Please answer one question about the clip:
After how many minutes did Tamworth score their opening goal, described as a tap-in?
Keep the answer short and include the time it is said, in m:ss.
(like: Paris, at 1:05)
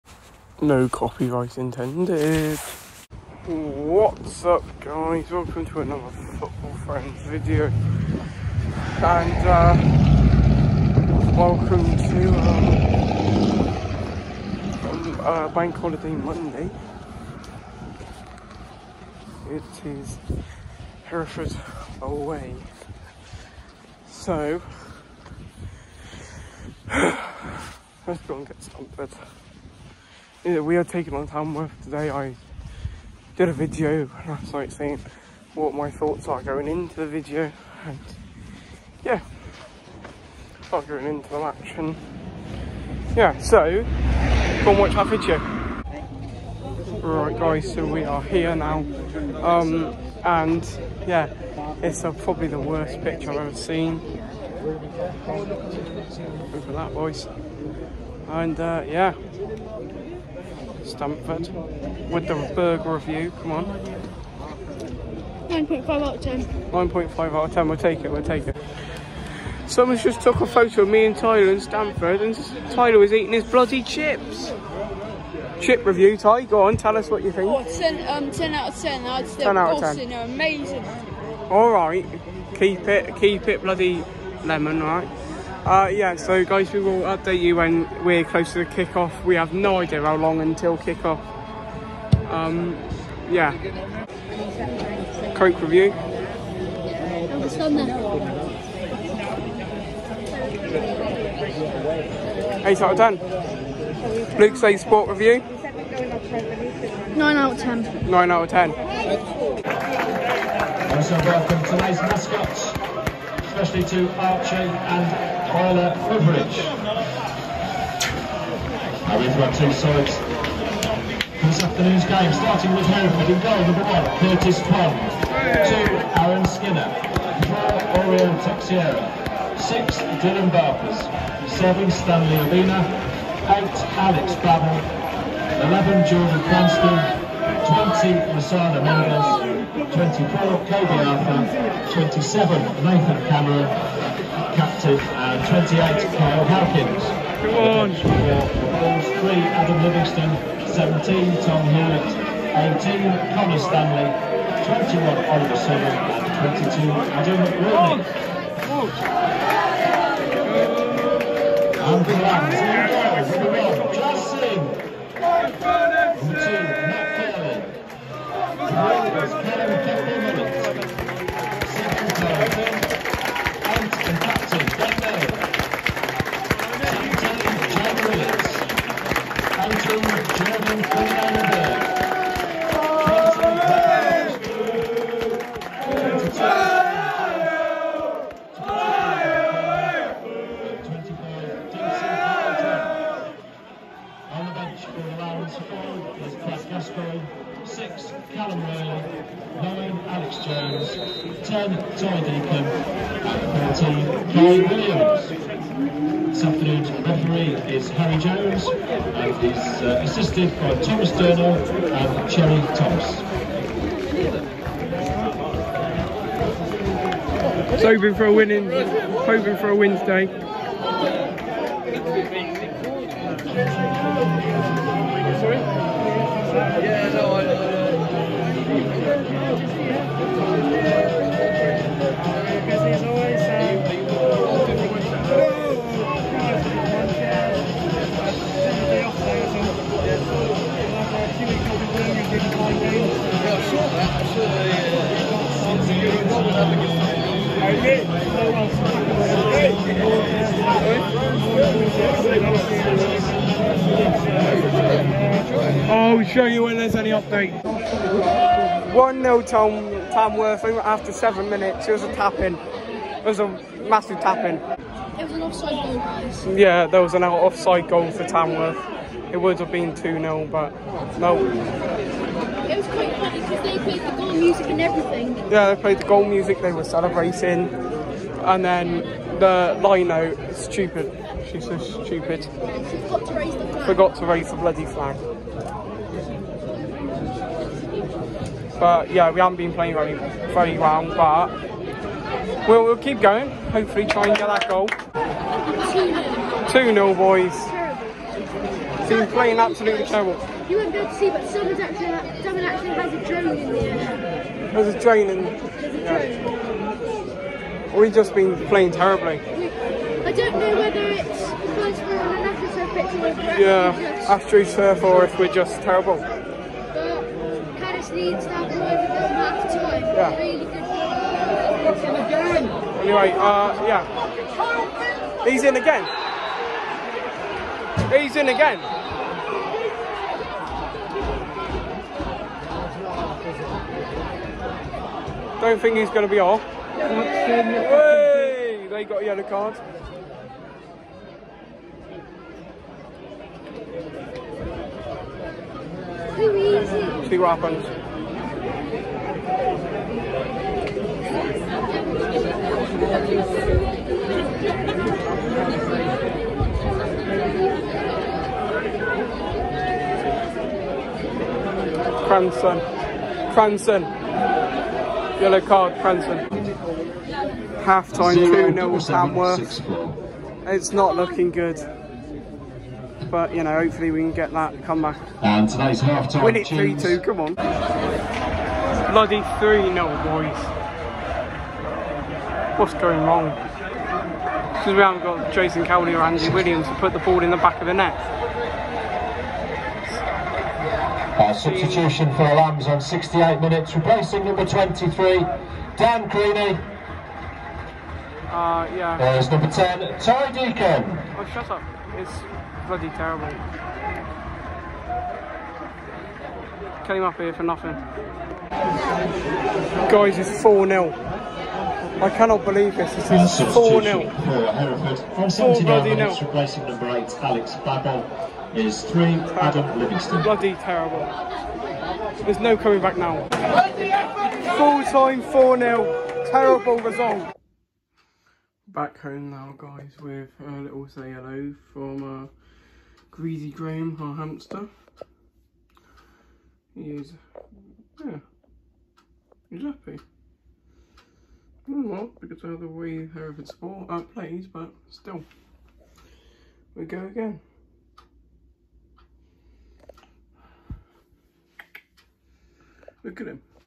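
7, at 4:21.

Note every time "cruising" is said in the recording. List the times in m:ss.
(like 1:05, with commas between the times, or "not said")
not said.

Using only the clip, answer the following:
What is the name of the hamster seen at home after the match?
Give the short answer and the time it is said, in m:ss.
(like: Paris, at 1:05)
Greasy Graham, at 7:13.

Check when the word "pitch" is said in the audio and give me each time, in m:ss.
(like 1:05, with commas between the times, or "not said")
0:53, 5:12.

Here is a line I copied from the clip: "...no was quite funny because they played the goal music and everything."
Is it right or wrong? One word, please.
right.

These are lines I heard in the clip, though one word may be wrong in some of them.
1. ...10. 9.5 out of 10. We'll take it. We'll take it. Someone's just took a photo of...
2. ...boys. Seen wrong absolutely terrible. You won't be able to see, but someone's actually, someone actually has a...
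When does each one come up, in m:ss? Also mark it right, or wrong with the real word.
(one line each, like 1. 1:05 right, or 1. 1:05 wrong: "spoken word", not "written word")
1. 1:06 right
2. 4:57 wrong: "playing", not "wrong".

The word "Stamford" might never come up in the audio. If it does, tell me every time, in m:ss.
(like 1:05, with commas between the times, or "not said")
1:00, 1:11.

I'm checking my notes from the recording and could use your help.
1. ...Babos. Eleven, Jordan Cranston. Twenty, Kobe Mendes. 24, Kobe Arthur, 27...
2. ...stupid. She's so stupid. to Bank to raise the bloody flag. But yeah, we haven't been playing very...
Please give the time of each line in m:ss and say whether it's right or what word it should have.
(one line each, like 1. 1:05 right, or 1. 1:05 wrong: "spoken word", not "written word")
1. 2:14 wrong: "Masada", not "Kobe"
2. 4:40 wrong: "Forgot", not "Bank".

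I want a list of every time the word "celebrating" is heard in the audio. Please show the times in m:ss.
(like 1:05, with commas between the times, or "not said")
4:36.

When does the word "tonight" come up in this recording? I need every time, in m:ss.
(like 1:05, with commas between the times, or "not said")
1:51, 6:15.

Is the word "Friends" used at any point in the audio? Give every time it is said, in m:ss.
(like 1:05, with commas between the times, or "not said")
0:06.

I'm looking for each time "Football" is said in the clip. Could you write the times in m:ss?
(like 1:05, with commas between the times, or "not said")
0:06.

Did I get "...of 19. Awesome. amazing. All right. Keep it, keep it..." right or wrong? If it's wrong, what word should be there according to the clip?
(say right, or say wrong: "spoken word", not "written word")
wrong: "10", not "19".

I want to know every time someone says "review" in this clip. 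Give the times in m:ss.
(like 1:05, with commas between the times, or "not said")
1:02, 1:15, 1:35, 1:45.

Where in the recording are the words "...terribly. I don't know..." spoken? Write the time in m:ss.
5:08.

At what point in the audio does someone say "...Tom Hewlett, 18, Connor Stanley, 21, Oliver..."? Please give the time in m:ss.
2:31.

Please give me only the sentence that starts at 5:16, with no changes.
But Caddis needs that all over the half time.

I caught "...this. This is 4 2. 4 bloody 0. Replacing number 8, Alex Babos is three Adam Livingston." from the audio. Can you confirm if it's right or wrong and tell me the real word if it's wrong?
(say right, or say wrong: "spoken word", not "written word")
wrong: "0", not "2".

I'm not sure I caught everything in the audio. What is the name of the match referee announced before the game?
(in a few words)
Harry Jones.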